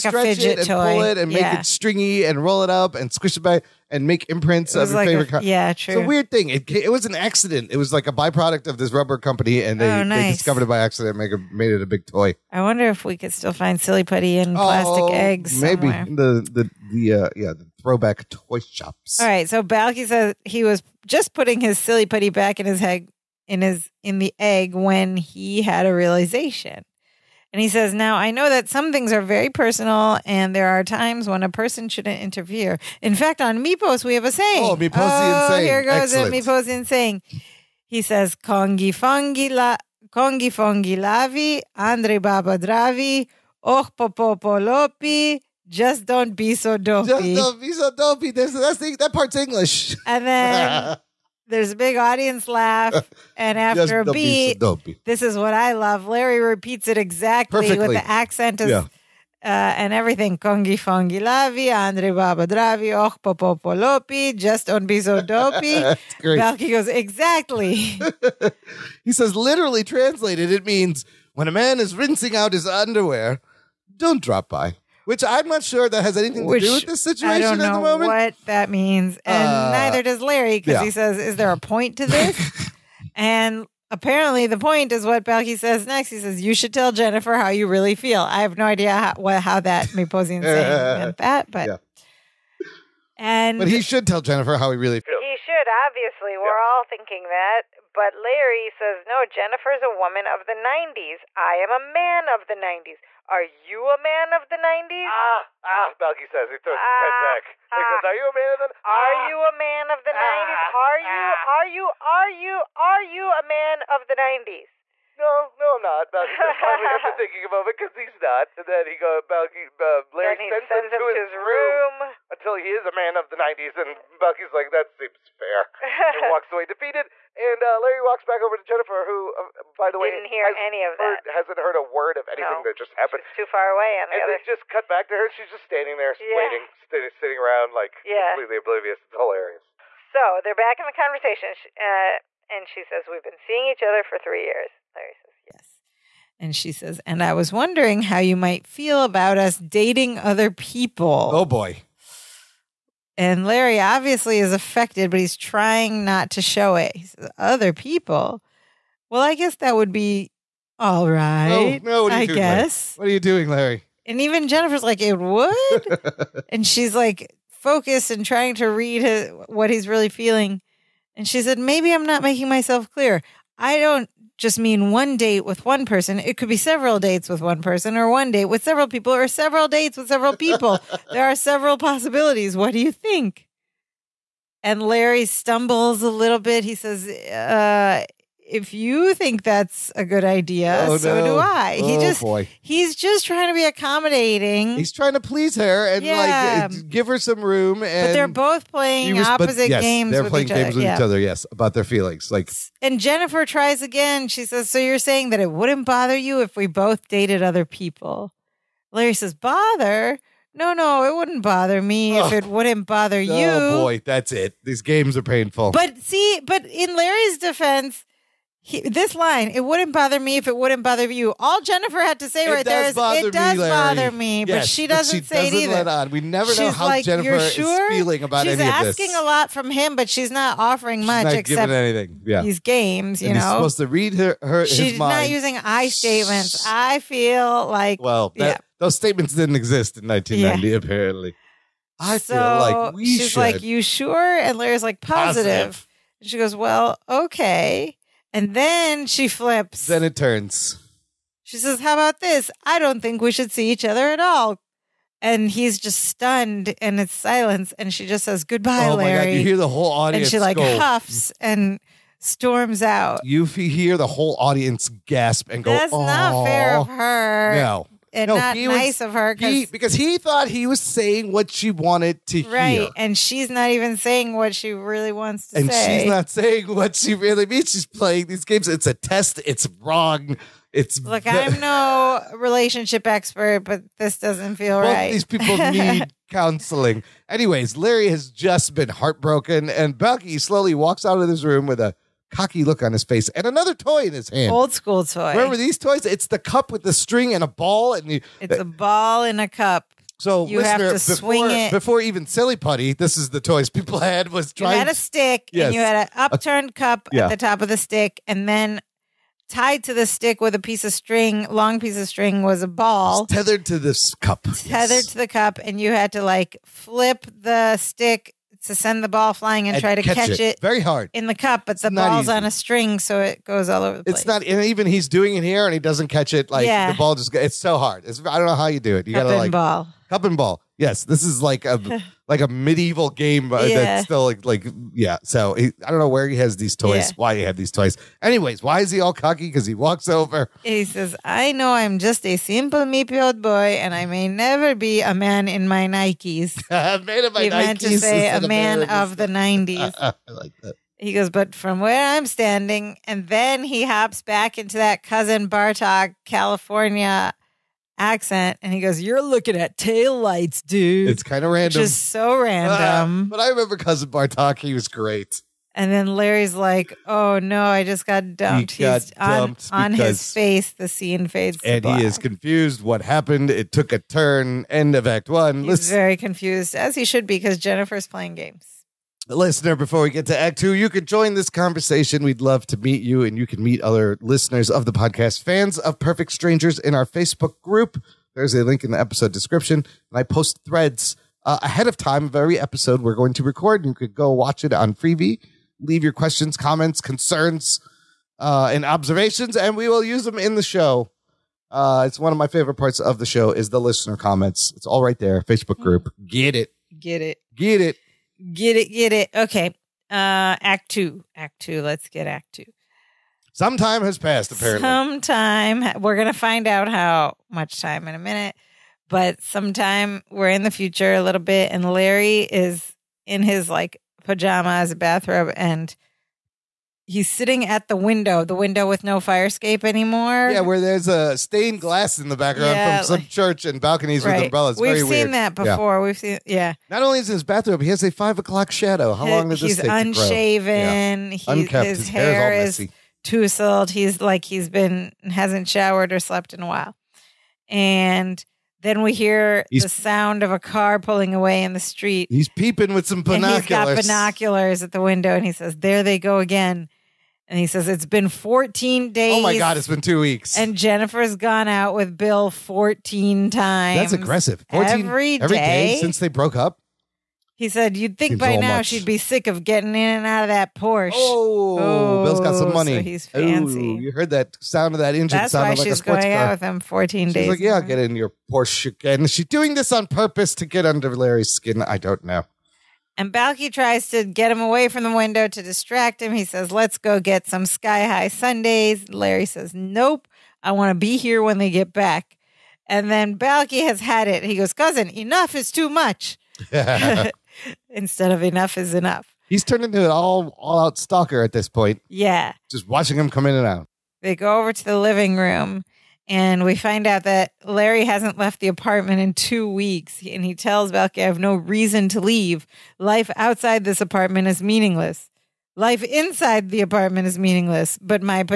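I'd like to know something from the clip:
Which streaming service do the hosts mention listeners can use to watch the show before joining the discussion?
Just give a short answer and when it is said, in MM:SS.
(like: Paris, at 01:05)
Freevee, at 06:34.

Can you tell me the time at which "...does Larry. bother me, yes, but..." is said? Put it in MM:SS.
03:43.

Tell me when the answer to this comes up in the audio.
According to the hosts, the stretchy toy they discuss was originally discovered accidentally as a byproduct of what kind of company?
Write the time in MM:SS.
00:08.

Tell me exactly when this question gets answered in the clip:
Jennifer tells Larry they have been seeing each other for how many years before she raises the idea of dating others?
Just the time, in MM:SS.
02:24.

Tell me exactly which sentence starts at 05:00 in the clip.
So you have to before, swing it before even silly putty.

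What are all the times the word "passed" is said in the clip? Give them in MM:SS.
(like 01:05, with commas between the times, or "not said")
06:54.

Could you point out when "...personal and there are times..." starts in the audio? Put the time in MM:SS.
00:29.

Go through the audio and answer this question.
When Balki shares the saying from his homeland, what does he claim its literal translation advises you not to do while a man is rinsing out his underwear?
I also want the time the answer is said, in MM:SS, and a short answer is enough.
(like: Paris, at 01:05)
drop by, at 01:14.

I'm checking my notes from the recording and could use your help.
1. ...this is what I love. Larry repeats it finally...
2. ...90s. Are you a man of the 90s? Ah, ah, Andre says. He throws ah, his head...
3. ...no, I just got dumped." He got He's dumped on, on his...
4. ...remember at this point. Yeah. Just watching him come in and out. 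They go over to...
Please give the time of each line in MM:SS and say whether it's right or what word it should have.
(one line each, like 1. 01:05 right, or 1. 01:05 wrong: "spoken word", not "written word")
1. 00:55 wrong: "exactly", not "finally"
2. 01:42 wrong: "Balki", not "Andre"
3. 06:07 right
4. 08:20 wrong: "stalker", not "remember".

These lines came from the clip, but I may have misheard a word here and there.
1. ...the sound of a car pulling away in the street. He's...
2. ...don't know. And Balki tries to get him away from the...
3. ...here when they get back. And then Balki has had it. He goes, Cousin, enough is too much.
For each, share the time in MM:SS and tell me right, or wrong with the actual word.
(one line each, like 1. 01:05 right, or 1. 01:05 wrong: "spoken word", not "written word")
1. 07:29 right
2. 08:01 right
3. 08:11 right.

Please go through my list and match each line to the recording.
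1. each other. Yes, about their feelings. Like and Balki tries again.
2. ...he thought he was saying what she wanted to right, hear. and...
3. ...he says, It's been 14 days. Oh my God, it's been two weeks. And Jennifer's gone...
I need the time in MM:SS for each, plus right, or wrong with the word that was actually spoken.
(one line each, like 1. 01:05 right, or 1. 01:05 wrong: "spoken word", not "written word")
1. 03:20 wrong: "Jennifer", not "Balki"
2. 04:29 right
3. 07:37 right.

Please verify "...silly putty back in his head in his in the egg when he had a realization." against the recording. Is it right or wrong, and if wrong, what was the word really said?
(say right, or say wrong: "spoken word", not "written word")
right.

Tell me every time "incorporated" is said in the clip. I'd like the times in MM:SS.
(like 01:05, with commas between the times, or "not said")
not said.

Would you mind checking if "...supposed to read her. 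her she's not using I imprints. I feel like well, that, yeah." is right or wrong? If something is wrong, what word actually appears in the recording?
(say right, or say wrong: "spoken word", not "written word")
wrong: "statements", not "imprints".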